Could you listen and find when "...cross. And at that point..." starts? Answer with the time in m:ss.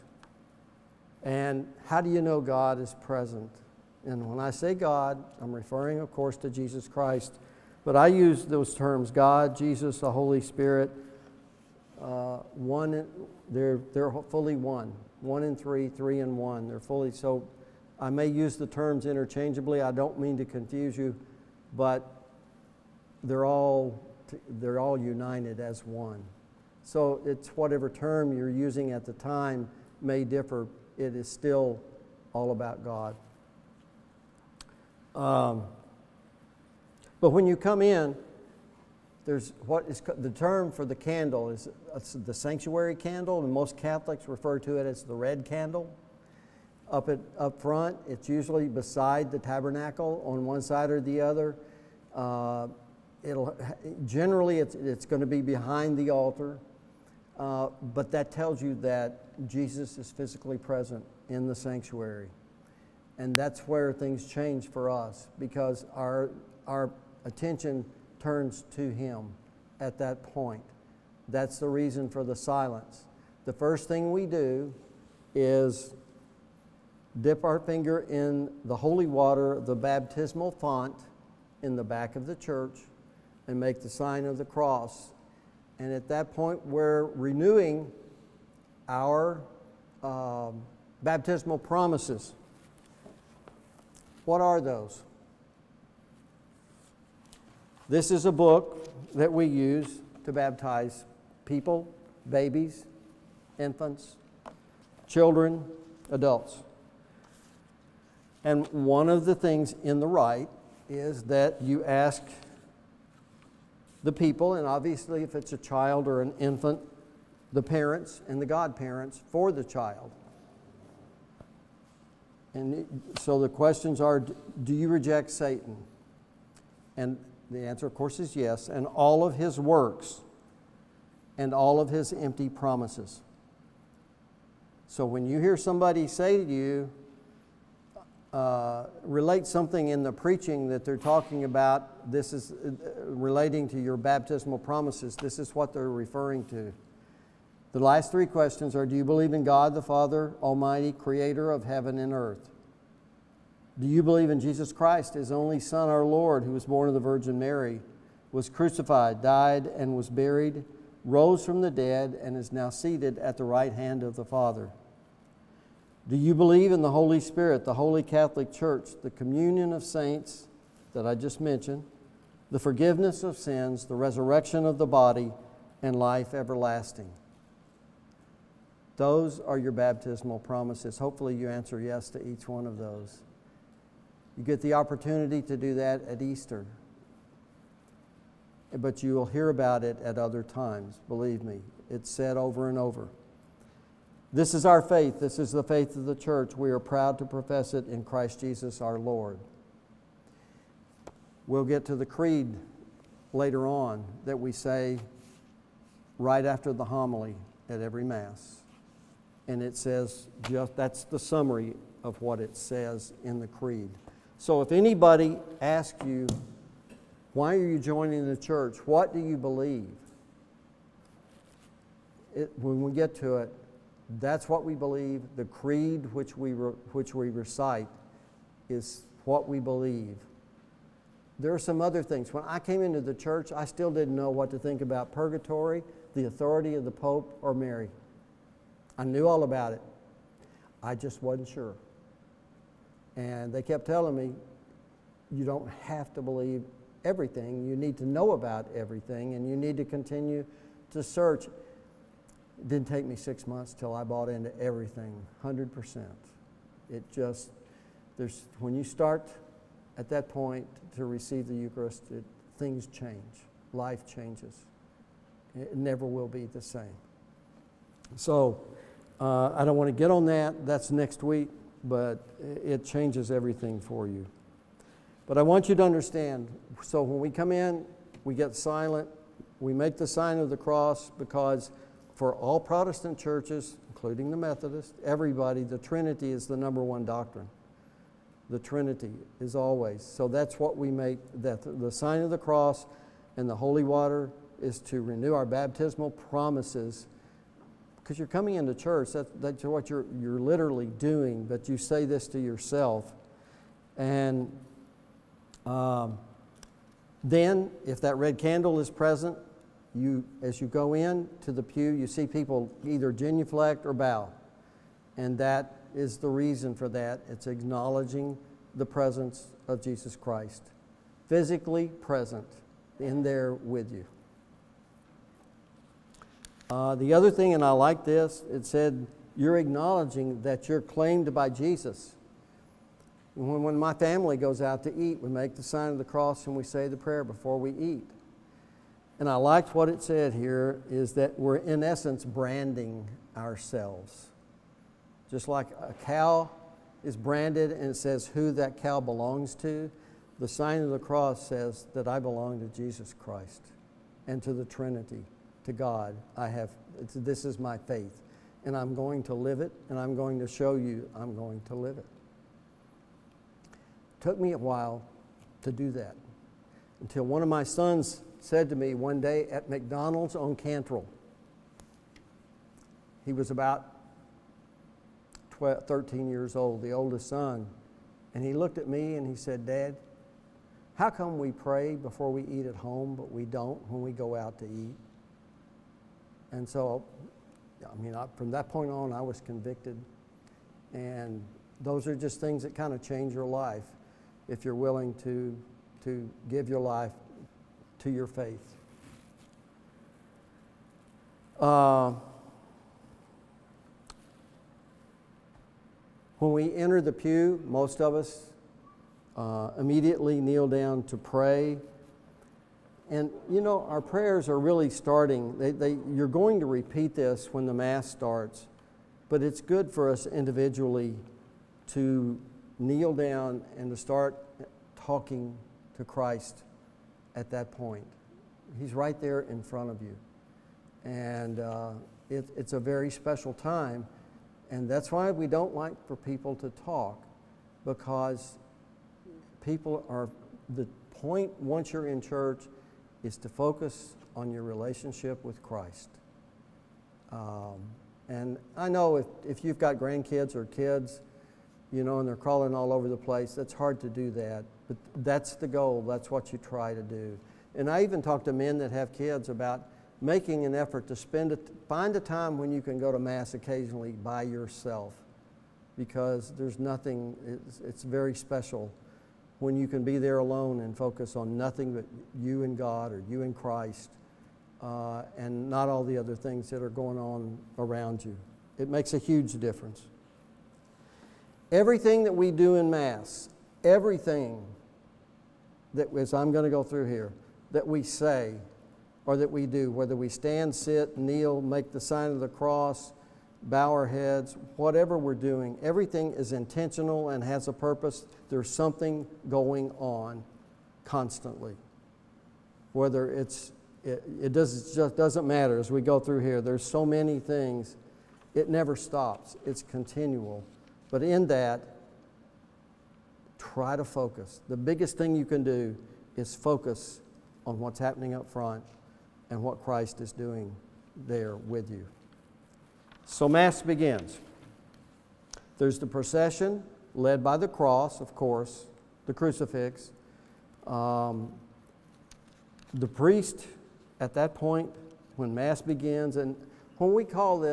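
1:24.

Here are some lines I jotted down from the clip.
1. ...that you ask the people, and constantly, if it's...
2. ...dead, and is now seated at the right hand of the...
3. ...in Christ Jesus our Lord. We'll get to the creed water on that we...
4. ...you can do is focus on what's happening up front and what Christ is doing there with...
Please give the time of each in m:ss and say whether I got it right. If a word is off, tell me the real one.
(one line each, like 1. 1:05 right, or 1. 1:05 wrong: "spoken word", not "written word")
1. 1:51 wrong: "obviously", not "constantly"
2. 2:41 right
3. 3:17 wrong: "later", not "water"
4. 8:35 right.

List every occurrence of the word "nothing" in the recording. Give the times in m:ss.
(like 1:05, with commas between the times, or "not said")
7:46, 7:51.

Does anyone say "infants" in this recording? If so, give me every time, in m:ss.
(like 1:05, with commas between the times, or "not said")
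1:43, 1:56.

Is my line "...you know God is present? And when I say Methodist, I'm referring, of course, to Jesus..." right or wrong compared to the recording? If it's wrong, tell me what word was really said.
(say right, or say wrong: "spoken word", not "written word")
wrong: "God", not "Methodist".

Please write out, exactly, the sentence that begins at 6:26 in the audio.
And so, I mean, I, from that point on, I was convicted.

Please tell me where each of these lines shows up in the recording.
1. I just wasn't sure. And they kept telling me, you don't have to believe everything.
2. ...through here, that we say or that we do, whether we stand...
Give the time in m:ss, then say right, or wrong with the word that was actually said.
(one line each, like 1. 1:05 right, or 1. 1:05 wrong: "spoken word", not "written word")
1. 4:00 right
2. 8:06 right.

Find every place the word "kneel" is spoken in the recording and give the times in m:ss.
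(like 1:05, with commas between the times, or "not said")
6:50, 7:02, 8:11.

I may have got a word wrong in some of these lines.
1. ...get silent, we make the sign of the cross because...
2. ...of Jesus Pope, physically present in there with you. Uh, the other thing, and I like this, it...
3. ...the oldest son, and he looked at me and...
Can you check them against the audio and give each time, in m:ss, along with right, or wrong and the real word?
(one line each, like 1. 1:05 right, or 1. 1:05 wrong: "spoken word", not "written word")
1. 4:38 right
2. 5:19 wrong: "Christ", not "Pope"
3. 6:16 right.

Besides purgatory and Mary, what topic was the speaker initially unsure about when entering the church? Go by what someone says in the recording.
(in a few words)
the authority of the Pope.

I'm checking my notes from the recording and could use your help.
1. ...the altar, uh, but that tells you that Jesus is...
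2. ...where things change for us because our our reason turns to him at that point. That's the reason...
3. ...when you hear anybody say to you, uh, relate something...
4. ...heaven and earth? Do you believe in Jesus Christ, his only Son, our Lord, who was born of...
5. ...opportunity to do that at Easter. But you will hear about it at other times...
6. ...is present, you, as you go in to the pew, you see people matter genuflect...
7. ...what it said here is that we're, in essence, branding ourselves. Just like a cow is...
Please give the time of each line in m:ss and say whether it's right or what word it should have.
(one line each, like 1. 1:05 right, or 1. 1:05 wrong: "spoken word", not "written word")
1. 0:55 right
2. 1:03 wrong: "attention", not "reason"
3. 2:15 wrong: "somebody", not "anybody"
4. 2:31 right
5. 3:04 right
6. 5:08 wrong: "either", not "matter"
7. 5:39 right.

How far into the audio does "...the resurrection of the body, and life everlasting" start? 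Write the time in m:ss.
2:53.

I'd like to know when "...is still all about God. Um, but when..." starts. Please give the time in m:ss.
0:31.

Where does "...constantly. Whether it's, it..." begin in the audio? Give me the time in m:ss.
8:21.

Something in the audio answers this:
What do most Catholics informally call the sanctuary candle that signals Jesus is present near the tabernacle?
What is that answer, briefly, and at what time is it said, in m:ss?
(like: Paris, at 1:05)
the red candle, at 0:45.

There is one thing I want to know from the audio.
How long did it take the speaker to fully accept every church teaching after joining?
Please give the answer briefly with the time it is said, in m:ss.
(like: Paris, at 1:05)
six months, at 4:13.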